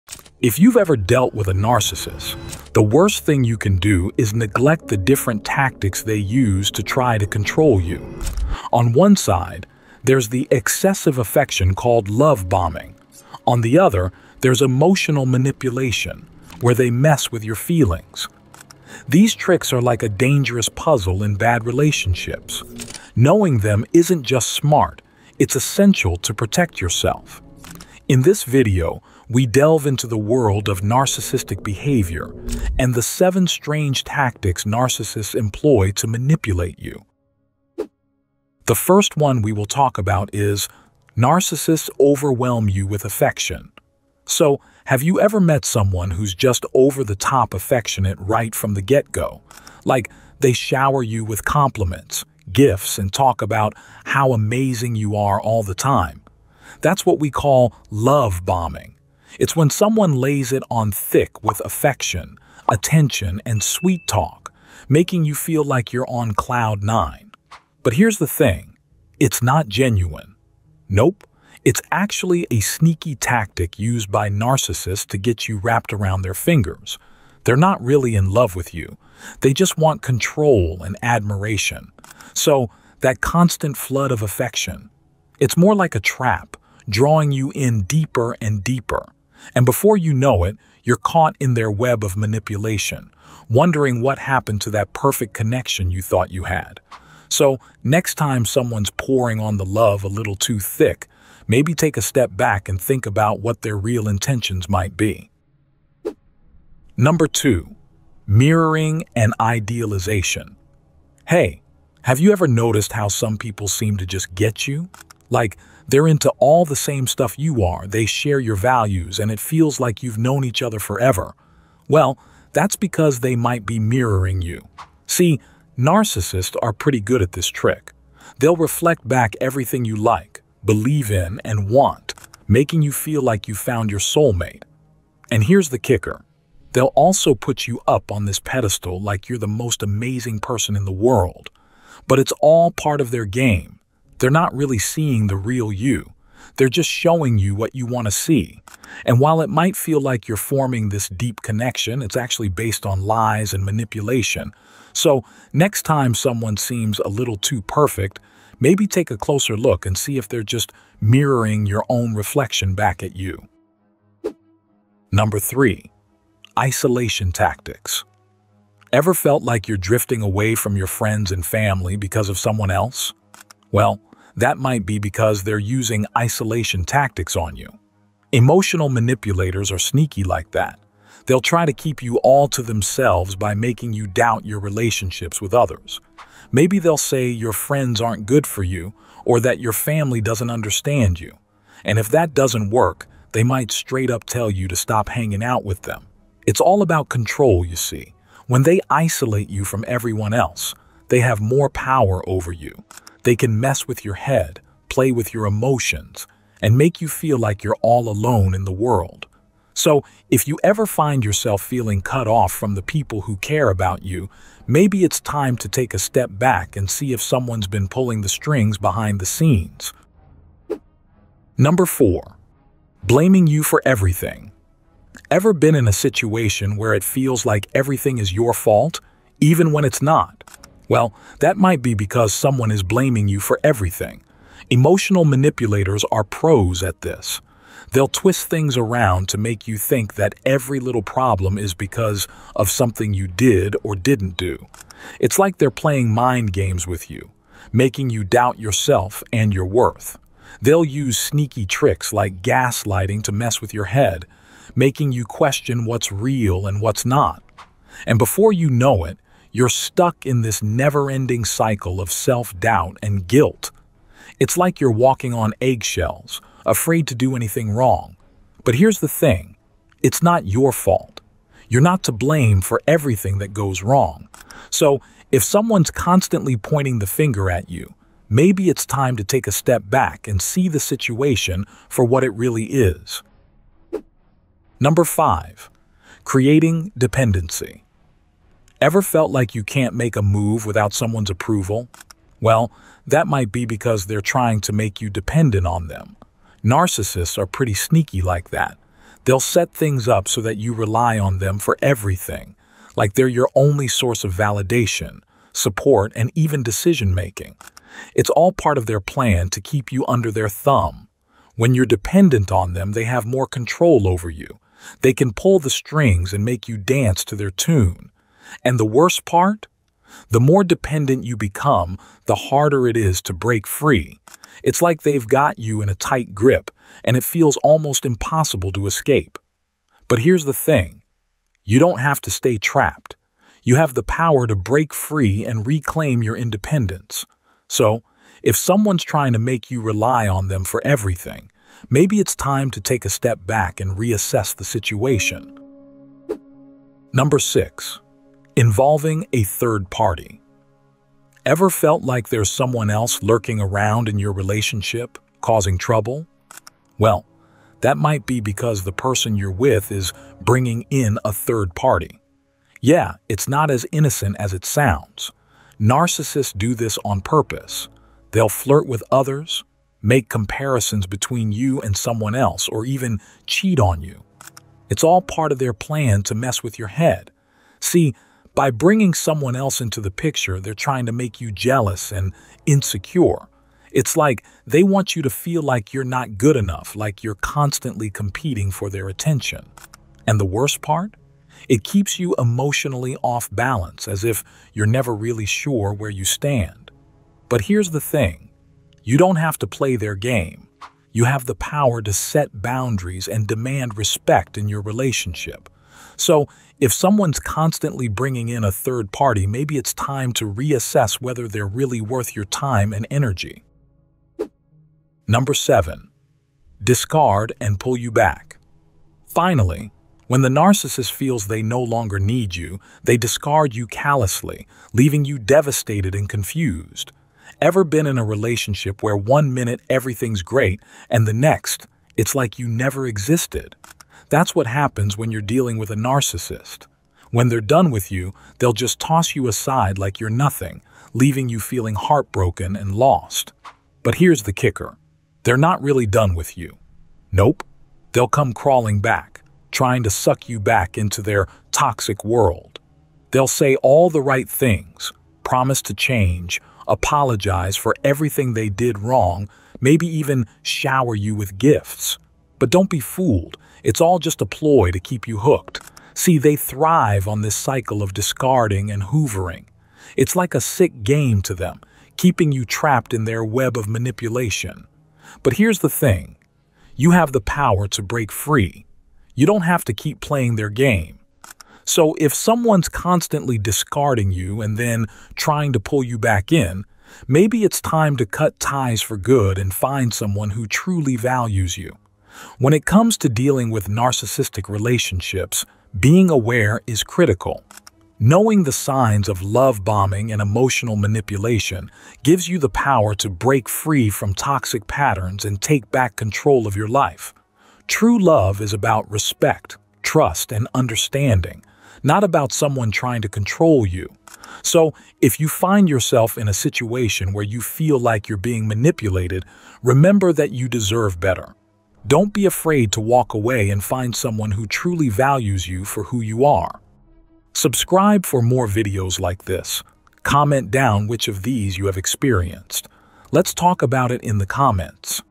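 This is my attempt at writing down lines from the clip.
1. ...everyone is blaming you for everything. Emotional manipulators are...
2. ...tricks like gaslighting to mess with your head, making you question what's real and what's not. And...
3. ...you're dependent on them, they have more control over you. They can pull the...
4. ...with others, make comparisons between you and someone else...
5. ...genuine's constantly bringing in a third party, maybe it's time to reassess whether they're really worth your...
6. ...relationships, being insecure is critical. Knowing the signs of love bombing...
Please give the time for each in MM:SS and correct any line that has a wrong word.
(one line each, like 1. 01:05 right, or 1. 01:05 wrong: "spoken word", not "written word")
1. 03:52 wrong: "someone", not "everyone"
2. 04:11 right
3. 05:11 right
4. 06:08 right
5. 06:46 wrong: "someone", not "genuine"
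6. 08:14 wrong: "aware", not "insecure".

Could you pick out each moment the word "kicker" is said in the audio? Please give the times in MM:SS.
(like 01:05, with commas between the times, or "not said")
02:15, 07:24.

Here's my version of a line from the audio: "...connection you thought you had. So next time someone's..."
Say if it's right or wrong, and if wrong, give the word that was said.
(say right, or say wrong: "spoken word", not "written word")
right.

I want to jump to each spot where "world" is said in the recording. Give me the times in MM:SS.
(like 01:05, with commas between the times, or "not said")
00:30, 02:20, 03:28, 07:32.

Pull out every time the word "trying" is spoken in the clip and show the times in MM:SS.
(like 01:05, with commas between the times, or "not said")
04:54, 05:39, 06:20, 07:29, 08:05, 08:32.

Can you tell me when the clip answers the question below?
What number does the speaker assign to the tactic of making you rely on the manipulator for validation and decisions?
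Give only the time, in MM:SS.
04:44.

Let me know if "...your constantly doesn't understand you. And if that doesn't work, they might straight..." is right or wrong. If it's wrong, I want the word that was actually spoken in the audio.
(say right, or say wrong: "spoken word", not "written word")
wrong: "family", not "constantly".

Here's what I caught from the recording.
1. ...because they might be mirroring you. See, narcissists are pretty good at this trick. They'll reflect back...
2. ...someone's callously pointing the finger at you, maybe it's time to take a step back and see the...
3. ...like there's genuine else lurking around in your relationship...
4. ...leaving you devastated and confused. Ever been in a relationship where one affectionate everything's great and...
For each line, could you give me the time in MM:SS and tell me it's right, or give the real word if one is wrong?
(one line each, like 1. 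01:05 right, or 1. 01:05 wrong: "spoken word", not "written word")
1. 02:02 right
2. 04:35 wrong: "constantly", not "callously"
3. 05:52 wrong: "someone", not "genuine"
4. 07:04 wrong: "minute", not "affectionate".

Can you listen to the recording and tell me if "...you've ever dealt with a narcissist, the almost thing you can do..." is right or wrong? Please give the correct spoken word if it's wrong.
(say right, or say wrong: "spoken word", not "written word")
wrong: "worst", not "almost".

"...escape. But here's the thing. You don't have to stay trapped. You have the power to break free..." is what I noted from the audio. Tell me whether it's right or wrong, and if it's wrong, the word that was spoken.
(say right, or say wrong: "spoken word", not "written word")
right.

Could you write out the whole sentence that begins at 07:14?
That's what happens when you're dealing with a narcissist.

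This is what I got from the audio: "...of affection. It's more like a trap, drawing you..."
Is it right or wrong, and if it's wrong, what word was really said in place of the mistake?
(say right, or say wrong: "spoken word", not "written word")
right.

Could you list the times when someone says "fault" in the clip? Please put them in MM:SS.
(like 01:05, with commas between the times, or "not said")
03:48, 04:30.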